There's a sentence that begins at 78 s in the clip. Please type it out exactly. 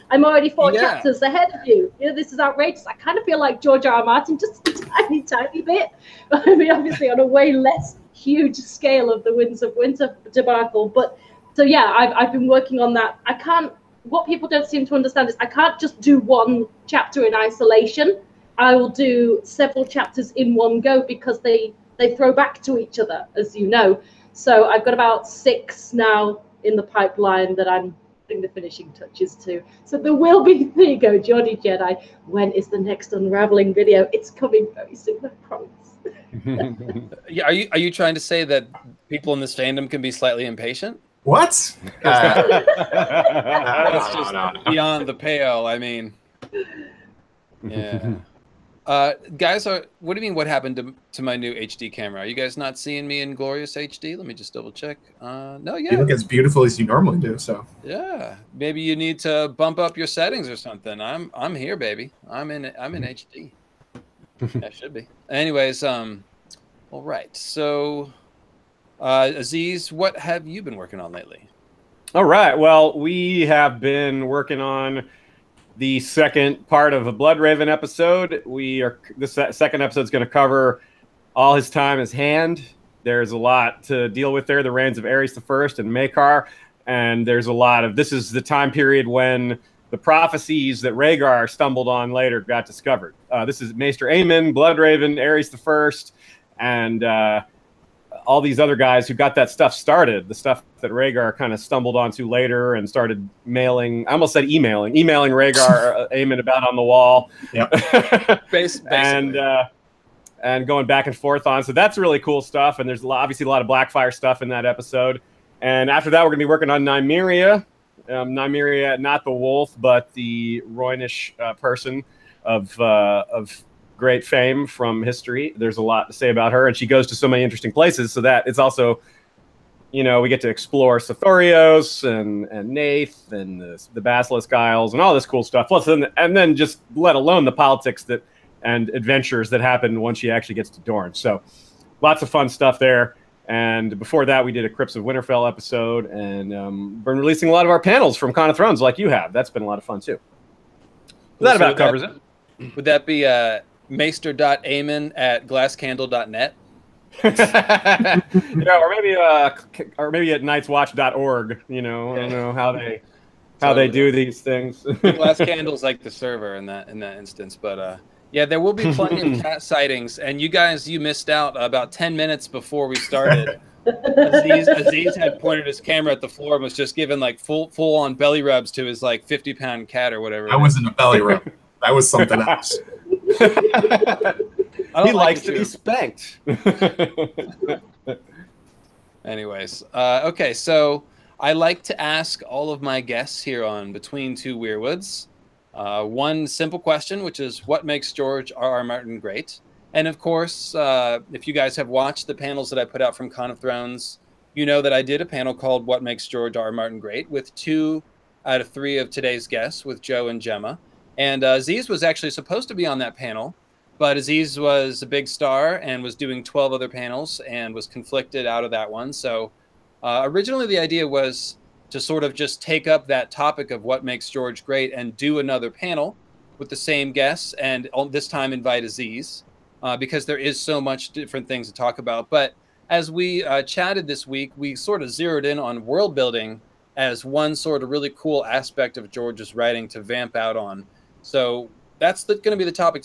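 We are this second episode is going to cover all his time as hand.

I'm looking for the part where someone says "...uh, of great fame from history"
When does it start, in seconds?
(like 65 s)
122 s.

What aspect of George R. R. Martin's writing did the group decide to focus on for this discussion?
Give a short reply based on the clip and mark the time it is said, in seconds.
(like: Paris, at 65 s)
World building, at 235 s.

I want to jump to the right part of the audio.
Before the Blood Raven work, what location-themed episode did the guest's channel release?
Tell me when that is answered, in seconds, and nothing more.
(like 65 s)
144 s.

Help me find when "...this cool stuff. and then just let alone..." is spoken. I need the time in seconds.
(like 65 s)
135 s.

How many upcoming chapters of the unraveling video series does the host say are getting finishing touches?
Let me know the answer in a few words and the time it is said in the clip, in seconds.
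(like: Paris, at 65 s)
6, at 25 s.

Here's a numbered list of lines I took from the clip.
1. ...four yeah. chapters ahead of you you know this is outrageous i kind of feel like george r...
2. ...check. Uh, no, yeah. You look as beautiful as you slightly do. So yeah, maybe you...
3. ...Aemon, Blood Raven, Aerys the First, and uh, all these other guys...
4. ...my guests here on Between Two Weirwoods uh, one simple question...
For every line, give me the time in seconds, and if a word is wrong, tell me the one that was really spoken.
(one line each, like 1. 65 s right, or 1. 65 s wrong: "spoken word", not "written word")
1. 0 s right
2. 54 s wrong: "normally", not "slightly"
3. 94 s right
4. 192 s right.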